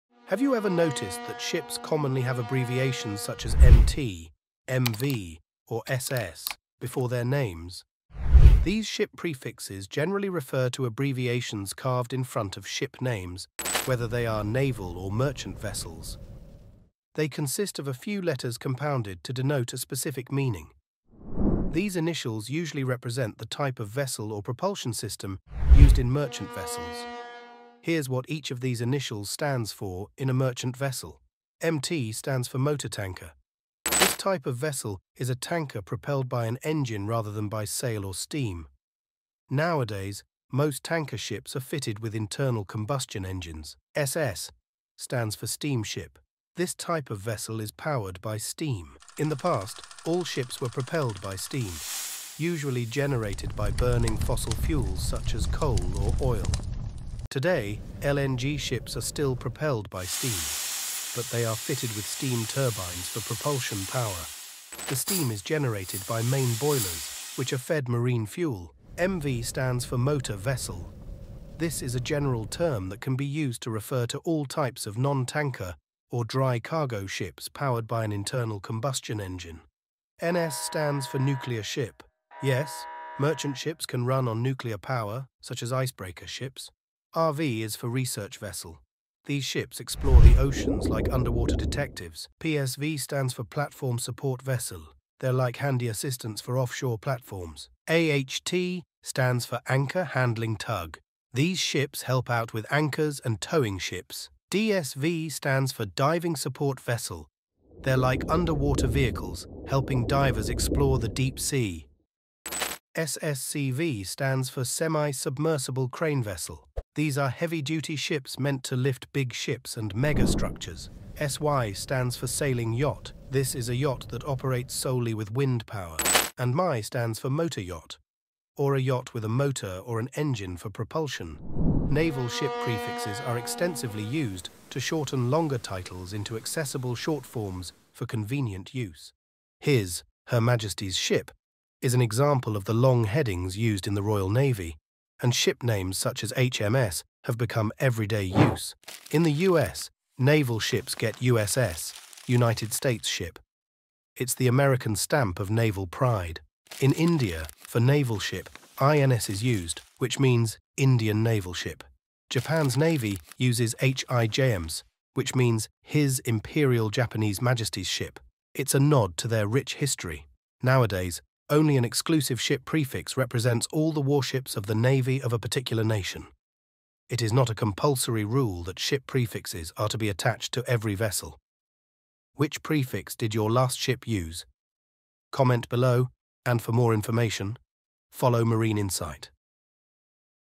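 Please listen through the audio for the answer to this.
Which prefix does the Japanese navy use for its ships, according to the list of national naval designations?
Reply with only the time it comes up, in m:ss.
2:43.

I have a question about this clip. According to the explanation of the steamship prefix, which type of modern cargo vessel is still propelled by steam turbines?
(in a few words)
LNG ships.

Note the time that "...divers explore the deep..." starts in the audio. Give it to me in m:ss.
1:50.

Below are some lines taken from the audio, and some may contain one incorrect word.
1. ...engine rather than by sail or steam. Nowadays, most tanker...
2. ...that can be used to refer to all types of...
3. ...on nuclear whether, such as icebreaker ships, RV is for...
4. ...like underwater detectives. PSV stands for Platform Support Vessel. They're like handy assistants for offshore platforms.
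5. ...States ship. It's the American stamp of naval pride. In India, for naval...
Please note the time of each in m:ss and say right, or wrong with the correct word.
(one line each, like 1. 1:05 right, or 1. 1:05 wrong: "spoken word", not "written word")
1. 0:36 right
2. 1:12 right
3. 1:24 wrong: "power", not "whether"
4. 1:30 right
5. 2:32 right.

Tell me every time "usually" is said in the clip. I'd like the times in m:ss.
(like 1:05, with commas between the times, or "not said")
0:22, 0:52.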